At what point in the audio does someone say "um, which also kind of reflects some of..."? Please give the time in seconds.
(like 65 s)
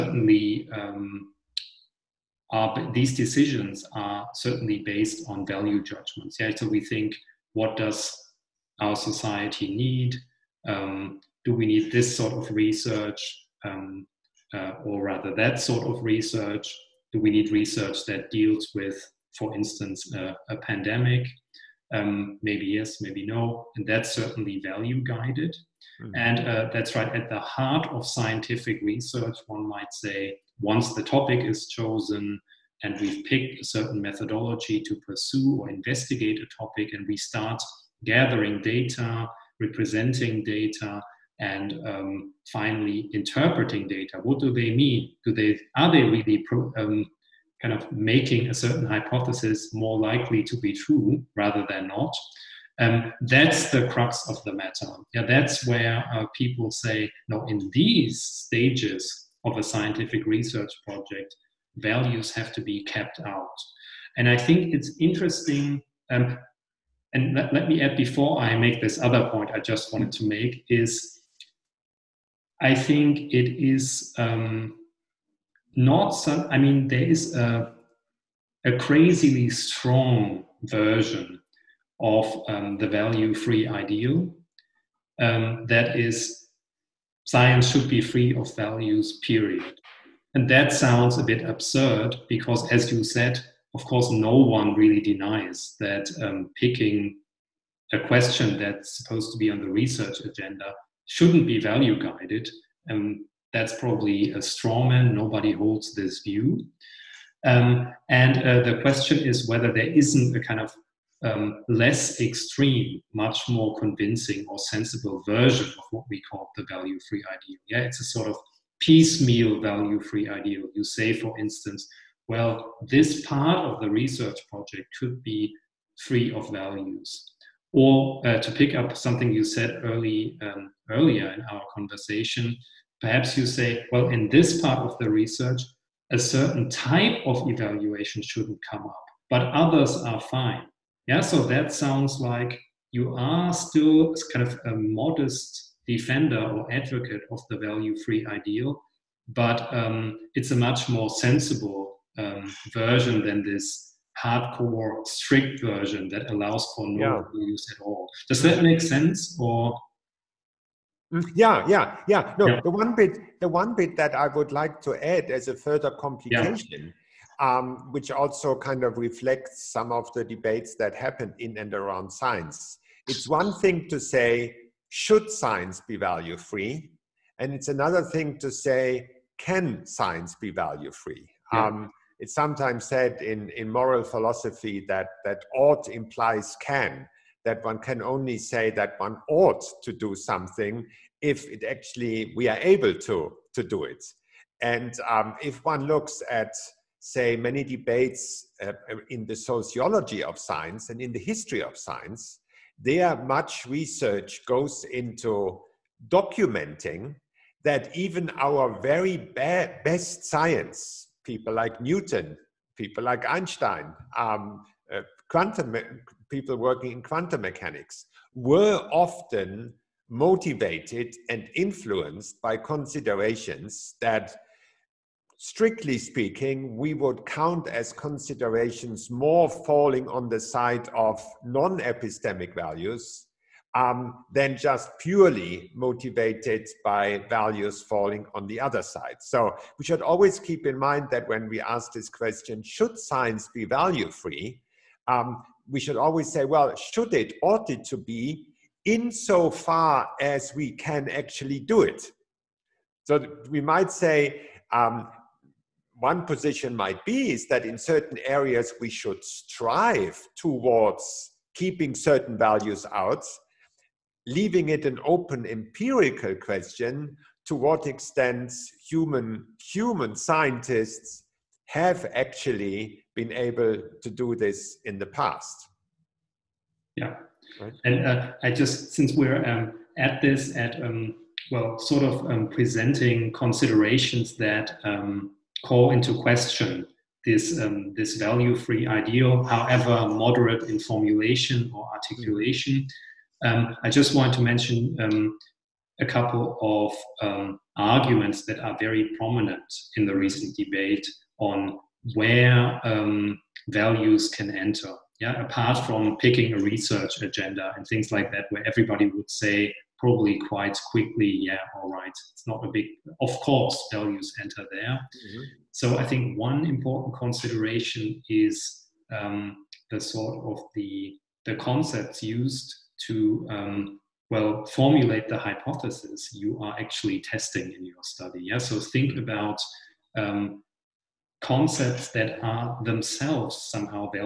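167 s.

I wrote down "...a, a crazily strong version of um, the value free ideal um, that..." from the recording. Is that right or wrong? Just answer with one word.
right.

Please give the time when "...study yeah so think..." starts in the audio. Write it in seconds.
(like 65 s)
328 s.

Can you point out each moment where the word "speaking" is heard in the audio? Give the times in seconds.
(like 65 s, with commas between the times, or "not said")
225 s.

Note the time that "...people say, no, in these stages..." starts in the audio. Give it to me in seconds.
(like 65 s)
56 s.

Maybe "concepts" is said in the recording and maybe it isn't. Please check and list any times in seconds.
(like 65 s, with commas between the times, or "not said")
321 s, 331 s.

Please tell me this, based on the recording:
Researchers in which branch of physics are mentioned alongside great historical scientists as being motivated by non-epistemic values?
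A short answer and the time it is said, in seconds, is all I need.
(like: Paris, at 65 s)
quantum mechanics, at 217 s.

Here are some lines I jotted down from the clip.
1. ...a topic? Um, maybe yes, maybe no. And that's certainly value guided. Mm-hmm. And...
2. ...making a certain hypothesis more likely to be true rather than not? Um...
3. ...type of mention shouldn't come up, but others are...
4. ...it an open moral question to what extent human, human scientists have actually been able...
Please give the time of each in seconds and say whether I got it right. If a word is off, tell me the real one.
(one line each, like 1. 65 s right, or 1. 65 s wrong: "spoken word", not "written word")
1. 20 s wrong: "pandemic", not "topic"
2. 47 s right
3. 136 s wrong: "evaluation", not "mention"
4. 264 s wrong: "empirical", not "moral".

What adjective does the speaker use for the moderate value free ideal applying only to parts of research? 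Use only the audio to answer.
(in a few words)
piecemeal.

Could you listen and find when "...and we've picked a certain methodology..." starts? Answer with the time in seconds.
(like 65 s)
32 s.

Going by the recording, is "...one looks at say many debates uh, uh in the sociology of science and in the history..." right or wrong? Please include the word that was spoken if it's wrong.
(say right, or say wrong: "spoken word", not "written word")
right.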